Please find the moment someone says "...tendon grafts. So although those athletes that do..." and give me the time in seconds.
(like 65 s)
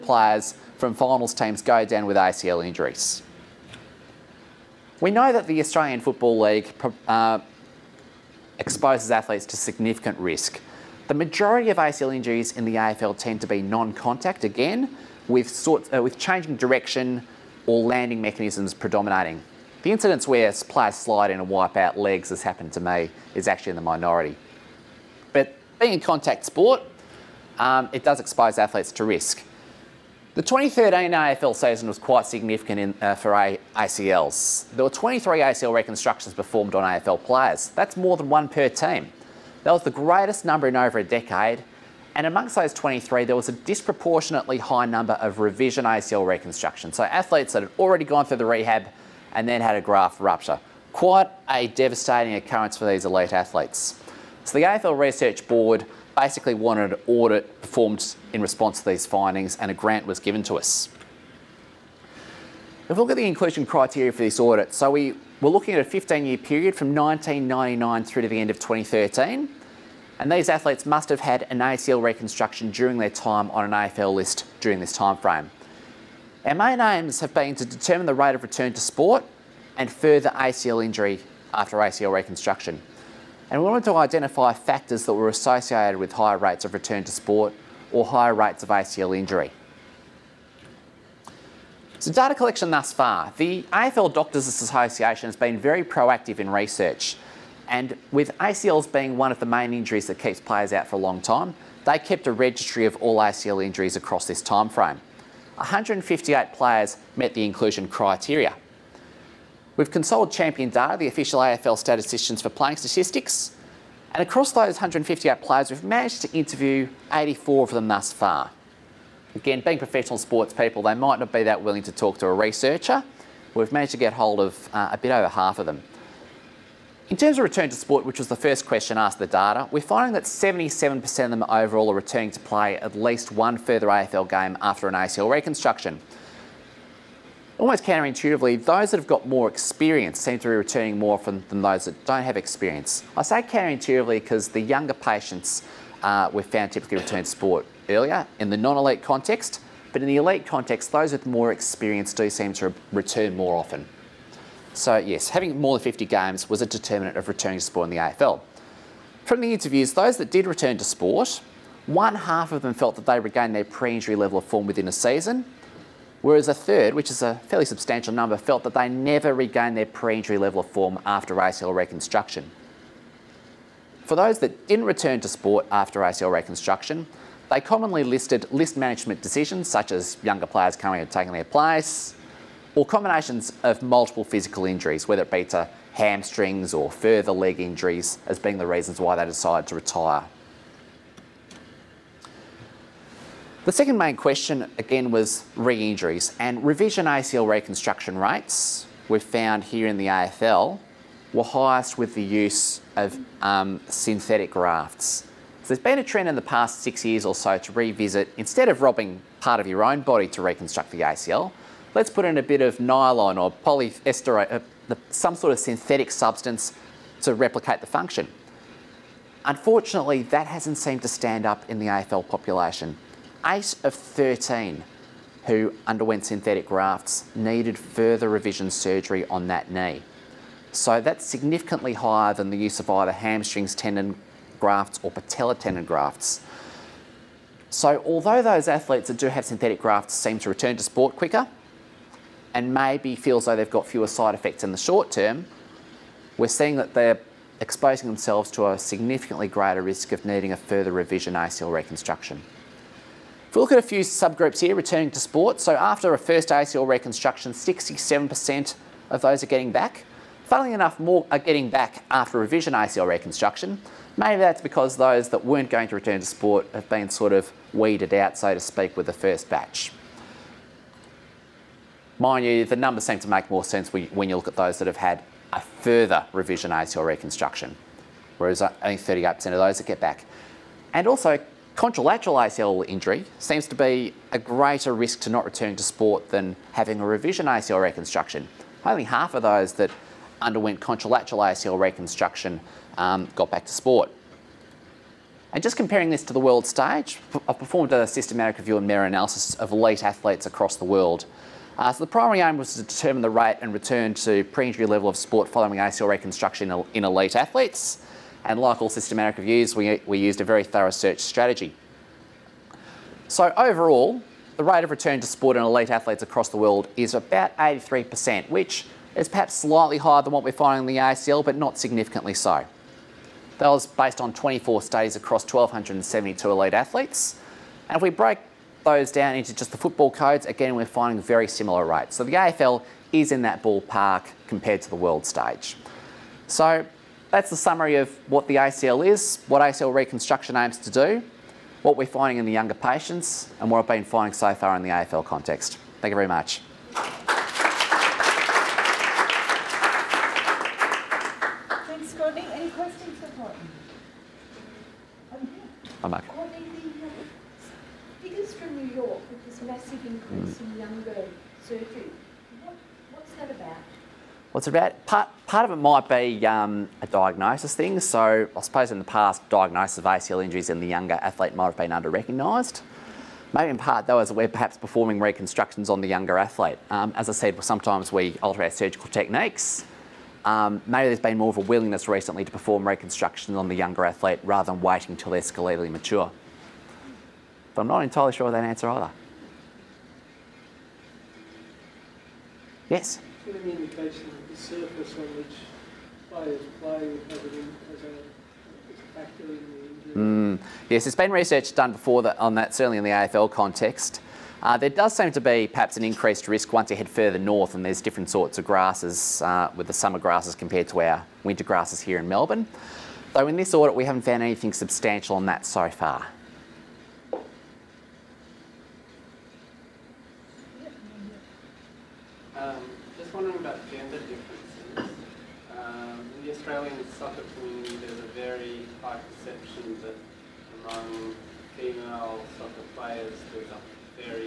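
235 s.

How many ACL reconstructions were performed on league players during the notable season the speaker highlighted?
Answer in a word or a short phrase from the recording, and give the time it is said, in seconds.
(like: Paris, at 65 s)
23, at 34 s.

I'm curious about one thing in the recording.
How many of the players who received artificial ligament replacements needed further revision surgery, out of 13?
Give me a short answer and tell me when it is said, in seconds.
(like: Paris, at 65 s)
8, at 223 s.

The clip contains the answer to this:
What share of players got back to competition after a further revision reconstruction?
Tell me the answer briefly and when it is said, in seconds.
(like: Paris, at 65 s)
38%, at 278 s.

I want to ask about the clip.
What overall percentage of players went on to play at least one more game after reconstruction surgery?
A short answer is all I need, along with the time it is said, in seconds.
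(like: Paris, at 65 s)
77%, at 130 s.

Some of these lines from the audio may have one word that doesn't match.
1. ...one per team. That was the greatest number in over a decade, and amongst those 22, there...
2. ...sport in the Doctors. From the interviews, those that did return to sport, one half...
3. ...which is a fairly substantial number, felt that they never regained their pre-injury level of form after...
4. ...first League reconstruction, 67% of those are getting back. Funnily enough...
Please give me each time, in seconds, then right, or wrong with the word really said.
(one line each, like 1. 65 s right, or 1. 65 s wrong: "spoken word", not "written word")
1. 38 s wrong: "23", not "22"
2. 157 s wrong: "AFL", not "Doctors"
3. 166 s right
4. 256 s wrong: "ACL", not "League".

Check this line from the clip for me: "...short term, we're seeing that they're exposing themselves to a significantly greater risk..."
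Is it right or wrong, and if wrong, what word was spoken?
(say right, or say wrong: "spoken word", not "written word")
right.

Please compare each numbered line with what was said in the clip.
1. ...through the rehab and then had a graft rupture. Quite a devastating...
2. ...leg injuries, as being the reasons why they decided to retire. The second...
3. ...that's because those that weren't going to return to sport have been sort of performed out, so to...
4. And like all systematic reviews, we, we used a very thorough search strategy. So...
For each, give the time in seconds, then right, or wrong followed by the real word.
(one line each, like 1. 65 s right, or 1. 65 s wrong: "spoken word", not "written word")
1. 48 s right
2. 187 s right
3. 264 s wrong: "weeded", not "performed"
4. 308 s right.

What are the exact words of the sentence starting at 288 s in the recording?
Only half of those that underwent contralateral ACL reconstruction um, got back to sport.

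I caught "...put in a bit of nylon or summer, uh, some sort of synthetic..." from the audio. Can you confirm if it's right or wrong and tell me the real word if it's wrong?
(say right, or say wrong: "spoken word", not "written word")
wrong: "polyester", not "summer".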